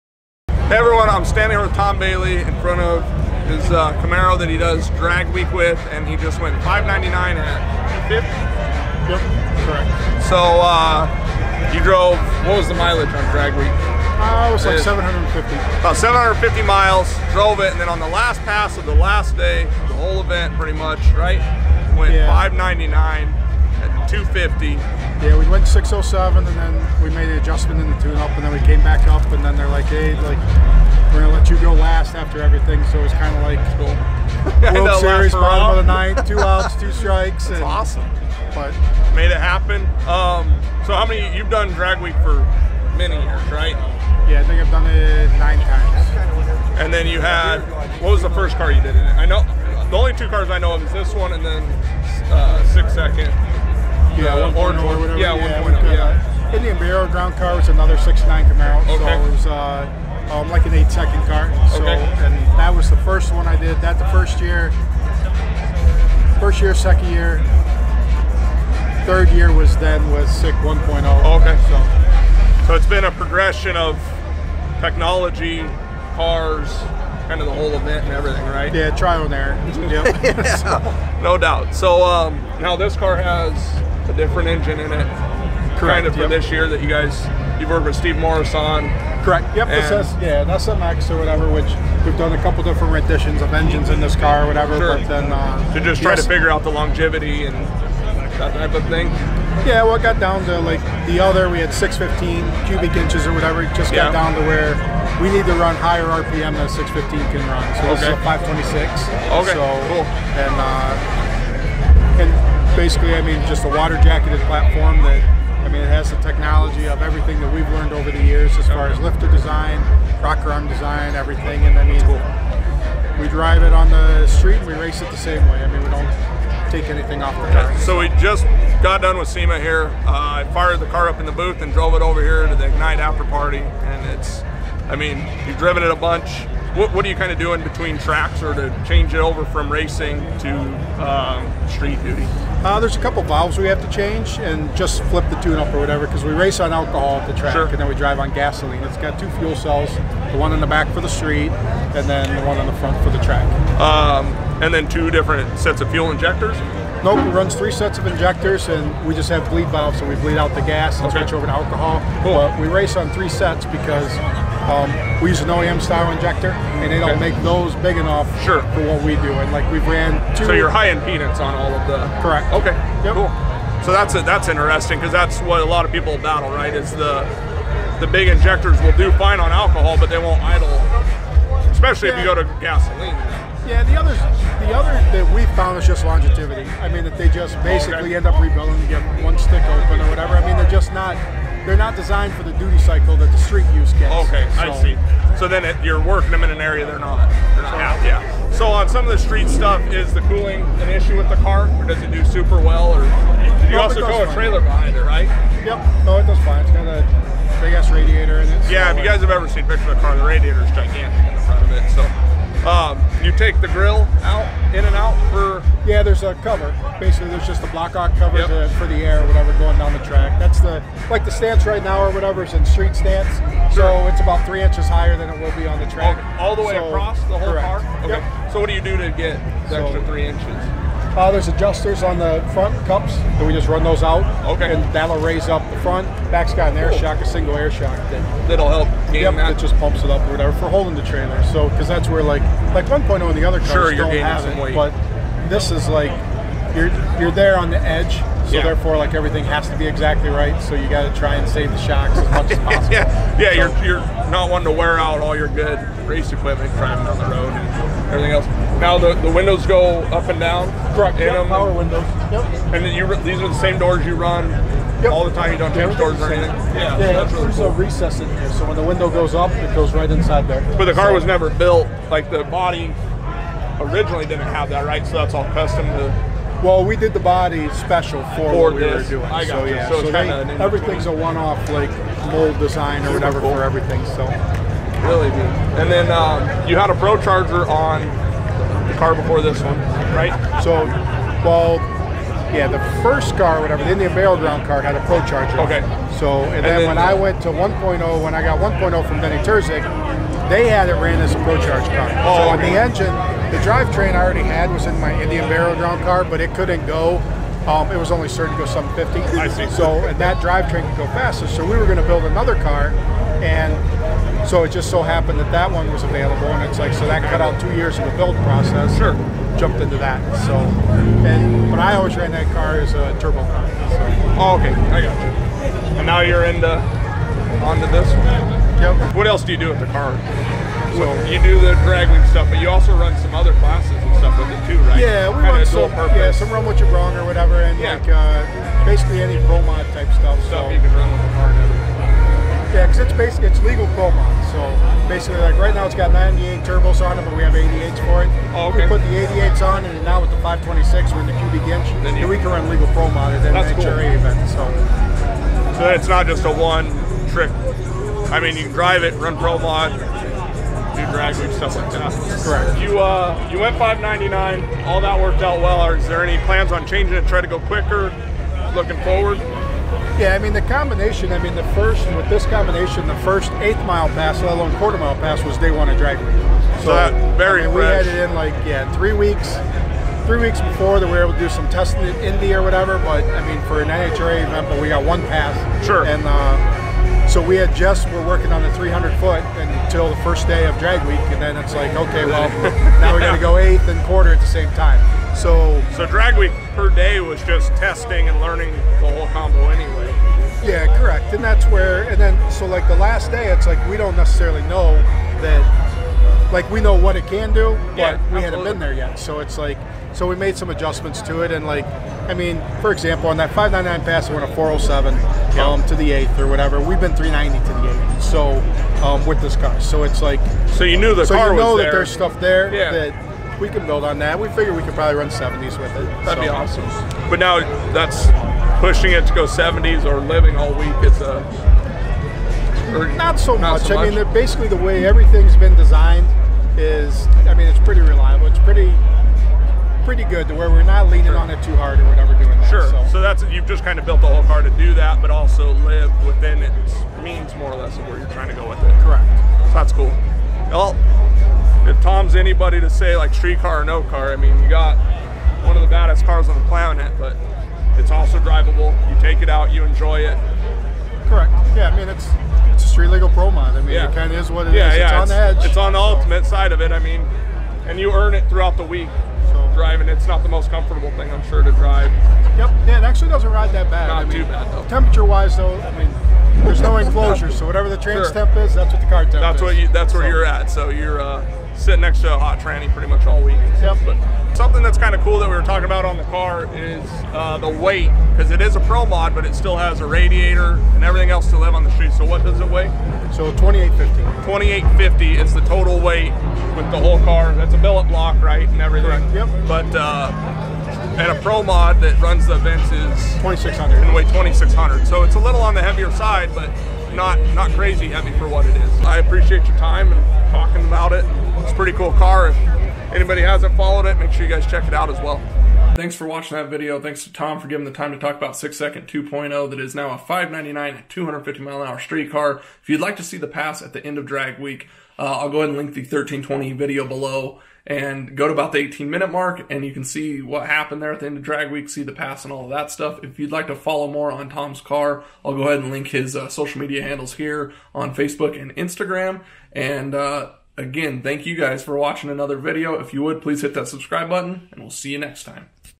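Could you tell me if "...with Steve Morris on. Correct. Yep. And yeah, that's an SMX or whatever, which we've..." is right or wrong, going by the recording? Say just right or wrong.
right.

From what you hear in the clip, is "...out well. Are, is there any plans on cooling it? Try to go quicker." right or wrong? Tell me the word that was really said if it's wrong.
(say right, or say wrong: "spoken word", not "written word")
wrong: "changing", not "cooling".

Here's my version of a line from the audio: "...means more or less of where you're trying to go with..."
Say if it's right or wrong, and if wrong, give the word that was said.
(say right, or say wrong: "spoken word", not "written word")
right.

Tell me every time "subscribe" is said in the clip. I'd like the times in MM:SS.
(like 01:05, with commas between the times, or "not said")
09:03.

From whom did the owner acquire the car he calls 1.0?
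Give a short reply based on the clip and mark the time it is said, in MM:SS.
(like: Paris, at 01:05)
Benny Terzik, at 04:59.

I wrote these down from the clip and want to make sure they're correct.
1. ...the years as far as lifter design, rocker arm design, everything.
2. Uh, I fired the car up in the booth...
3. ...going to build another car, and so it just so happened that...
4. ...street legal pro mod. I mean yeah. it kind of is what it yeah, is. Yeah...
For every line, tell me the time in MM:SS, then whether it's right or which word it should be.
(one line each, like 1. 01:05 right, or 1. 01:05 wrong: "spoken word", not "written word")
1. 01:58 right
2. 02:10 right
3. 05:11 right
4. 07:42 right.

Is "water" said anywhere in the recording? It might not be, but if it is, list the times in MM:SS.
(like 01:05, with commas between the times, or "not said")
01:53.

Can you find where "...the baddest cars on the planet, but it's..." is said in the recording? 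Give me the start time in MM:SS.
07:35.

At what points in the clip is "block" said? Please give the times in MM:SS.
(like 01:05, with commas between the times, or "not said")
03:37, 08:18.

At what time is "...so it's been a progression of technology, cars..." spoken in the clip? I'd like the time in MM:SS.
01:12.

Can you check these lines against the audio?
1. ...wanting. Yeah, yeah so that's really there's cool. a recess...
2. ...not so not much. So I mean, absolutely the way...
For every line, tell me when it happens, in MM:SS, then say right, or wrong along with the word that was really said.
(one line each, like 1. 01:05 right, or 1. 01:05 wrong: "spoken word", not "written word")
1. 04:26 wrong: "anything", not "wanting"
2. 07:13 wrong: "basically", not "absolutely".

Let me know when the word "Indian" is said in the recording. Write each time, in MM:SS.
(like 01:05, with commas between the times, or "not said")
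00:56, 04:53, 05:05.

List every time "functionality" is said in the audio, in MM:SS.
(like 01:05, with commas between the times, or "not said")
not said.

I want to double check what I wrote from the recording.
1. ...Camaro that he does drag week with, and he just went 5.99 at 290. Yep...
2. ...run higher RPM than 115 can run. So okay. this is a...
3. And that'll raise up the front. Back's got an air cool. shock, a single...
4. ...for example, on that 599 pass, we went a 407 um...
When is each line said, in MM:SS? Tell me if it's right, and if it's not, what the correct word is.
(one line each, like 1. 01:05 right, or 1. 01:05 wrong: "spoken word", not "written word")
1. 00:04 wrong: "250", not "290"
2. 01:45 wrong: "615", not "115"
3. 03:54 right
4. 06:52 right.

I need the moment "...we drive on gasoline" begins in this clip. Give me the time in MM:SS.
02:27.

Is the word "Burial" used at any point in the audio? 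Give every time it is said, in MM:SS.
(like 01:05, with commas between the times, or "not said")
00:56, 04:54, 05:05.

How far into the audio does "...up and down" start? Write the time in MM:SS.
04:20.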